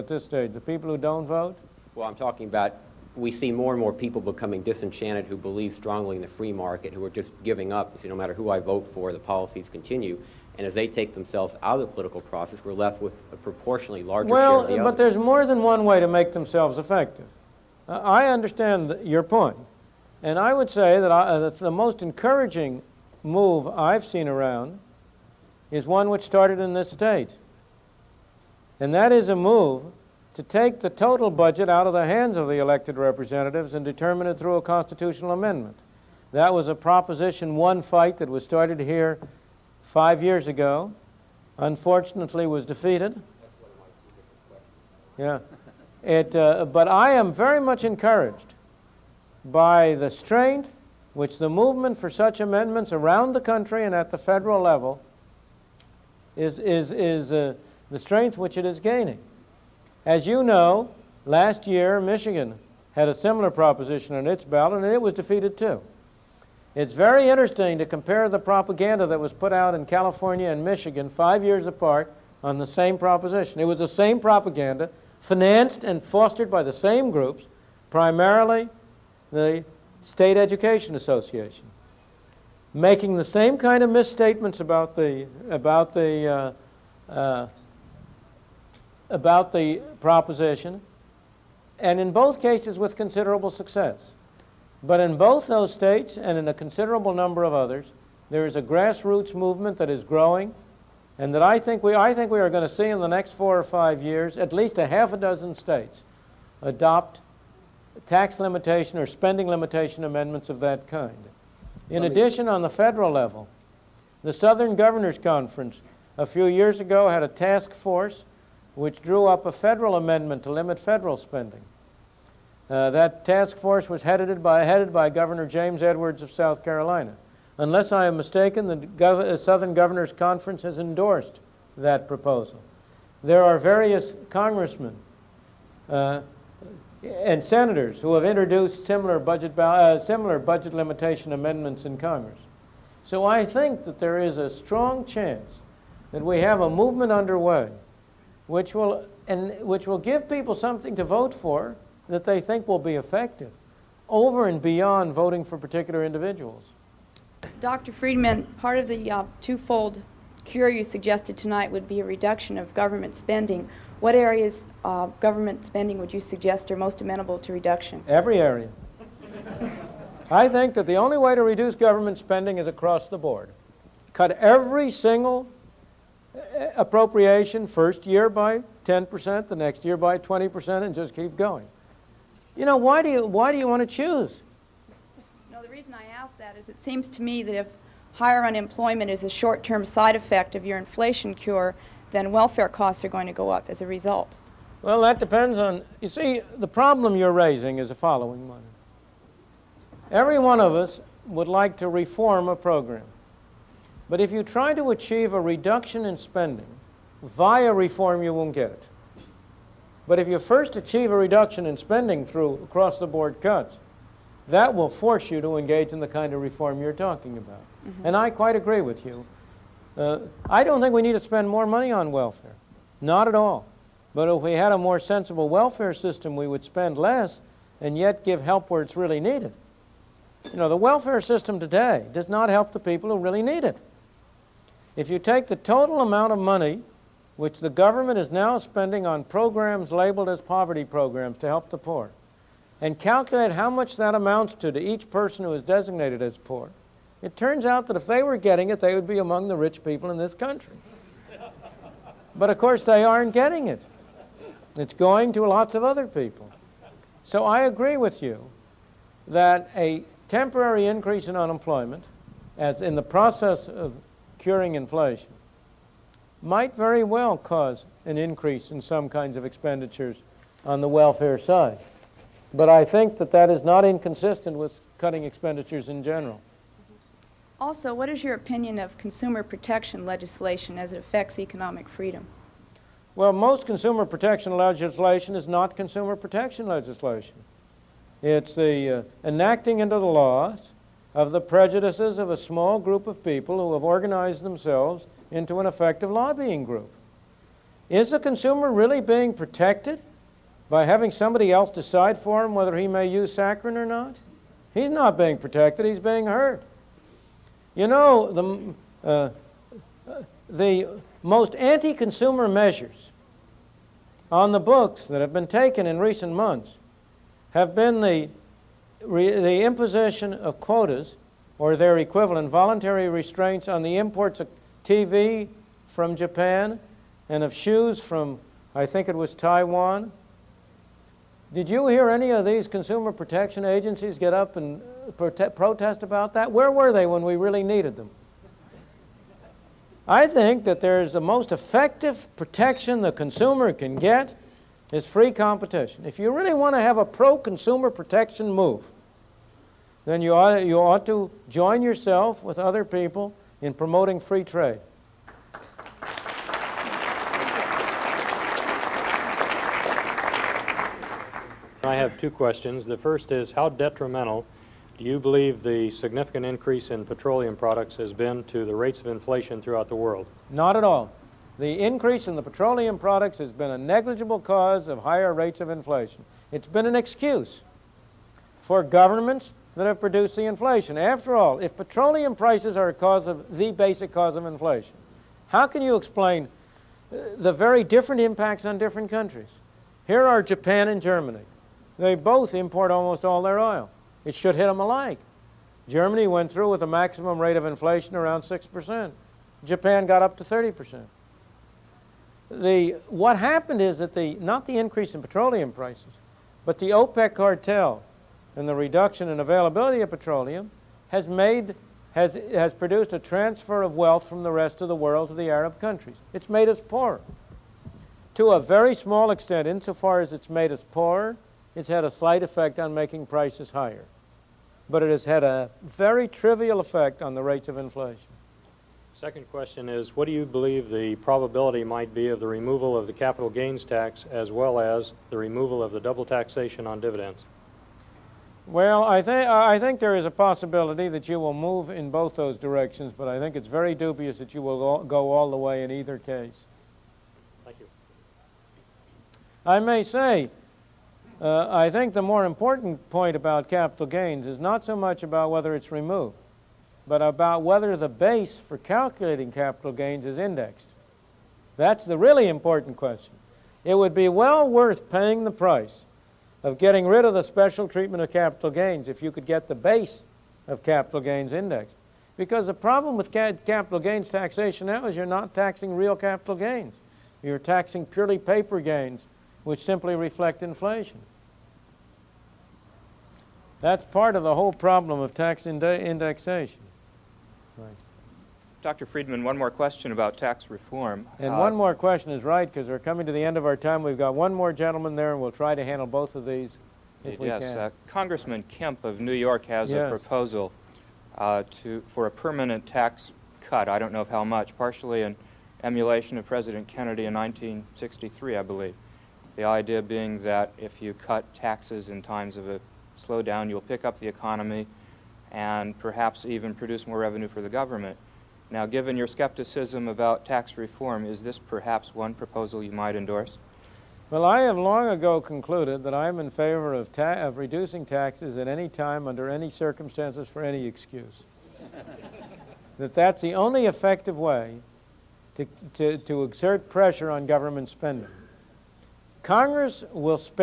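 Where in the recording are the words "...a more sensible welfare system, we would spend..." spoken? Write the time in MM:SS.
03:44.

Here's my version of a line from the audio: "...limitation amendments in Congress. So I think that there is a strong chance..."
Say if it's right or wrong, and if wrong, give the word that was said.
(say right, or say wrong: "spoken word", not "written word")
right.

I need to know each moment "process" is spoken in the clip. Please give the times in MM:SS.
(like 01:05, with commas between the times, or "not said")
00:12, 04:23.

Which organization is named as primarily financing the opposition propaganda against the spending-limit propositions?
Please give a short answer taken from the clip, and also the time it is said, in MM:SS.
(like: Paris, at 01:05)
State Education Association, at 01:20.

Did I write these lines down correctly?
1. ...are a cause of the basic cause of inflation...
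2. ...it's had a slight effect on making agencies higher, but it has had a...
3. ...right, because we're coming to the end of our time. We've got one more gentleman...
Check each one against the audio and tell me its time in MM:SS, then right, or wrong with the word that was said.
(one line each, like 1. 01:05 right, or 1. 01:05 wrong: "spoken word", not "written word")
1. 06:22 right
2. 07:01 wrong: "prices", not "agencies"
3. 08:12 right.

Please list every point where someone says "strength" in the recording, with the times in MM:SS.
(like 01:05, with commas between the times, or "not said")
00:50, 00:57.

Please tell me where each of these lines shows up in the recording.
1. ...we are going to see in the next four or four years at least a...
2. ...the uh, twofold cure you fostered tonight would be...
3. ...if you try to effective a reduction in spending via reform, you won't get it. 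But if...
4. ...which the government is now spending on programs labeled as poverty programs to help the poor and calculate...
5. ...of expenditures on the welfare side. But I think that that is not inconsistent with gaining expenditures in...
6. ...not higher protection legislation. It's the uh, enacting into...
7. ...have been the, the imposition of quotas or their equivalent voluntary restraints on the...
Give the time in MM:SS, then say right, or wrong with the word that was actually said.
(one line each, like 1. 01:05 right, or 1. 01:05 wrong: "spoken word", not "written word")
1. 01:42 wrong: "five", not "four"
2. 02:38 wrong: "suggested", not "fostered"
3. 03:24 wrong: "achieve", not "effective"
4. 03:57 right
5. 04:29 wrong: "cutting", not "gaining"
6. 04:45 wrong: "consumer", not "higher"
7. 05:17 right.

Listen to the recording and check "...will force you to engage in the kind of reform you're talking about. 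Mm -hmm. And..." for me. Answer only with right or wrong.
right.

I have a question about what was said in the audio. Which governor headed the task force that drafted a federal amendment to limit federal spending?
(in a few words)
James Edwards.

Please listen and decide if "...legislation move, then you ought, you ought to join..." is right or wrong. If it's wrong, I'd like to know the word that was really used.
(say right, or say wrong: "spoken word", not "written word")
wrong: "protection", not "legislation".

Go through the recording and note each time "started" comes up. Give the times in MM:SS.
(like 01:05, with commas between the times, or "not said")
00:26, 00:38.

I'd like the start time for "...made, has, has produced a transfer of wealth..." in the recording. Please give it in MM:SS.
06:51.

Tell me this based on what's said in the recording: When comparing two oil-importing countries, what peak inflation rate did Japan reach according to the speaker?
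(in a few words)
30%.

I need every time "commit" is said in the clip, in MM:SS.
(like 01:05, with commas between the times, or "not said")
not said.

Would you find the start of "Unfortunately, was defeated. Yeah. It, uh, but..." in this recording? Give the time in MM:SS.
00:41.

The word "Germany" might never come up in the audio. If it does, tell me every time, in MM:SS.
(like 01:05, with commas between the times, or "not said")
06:31, 06:35.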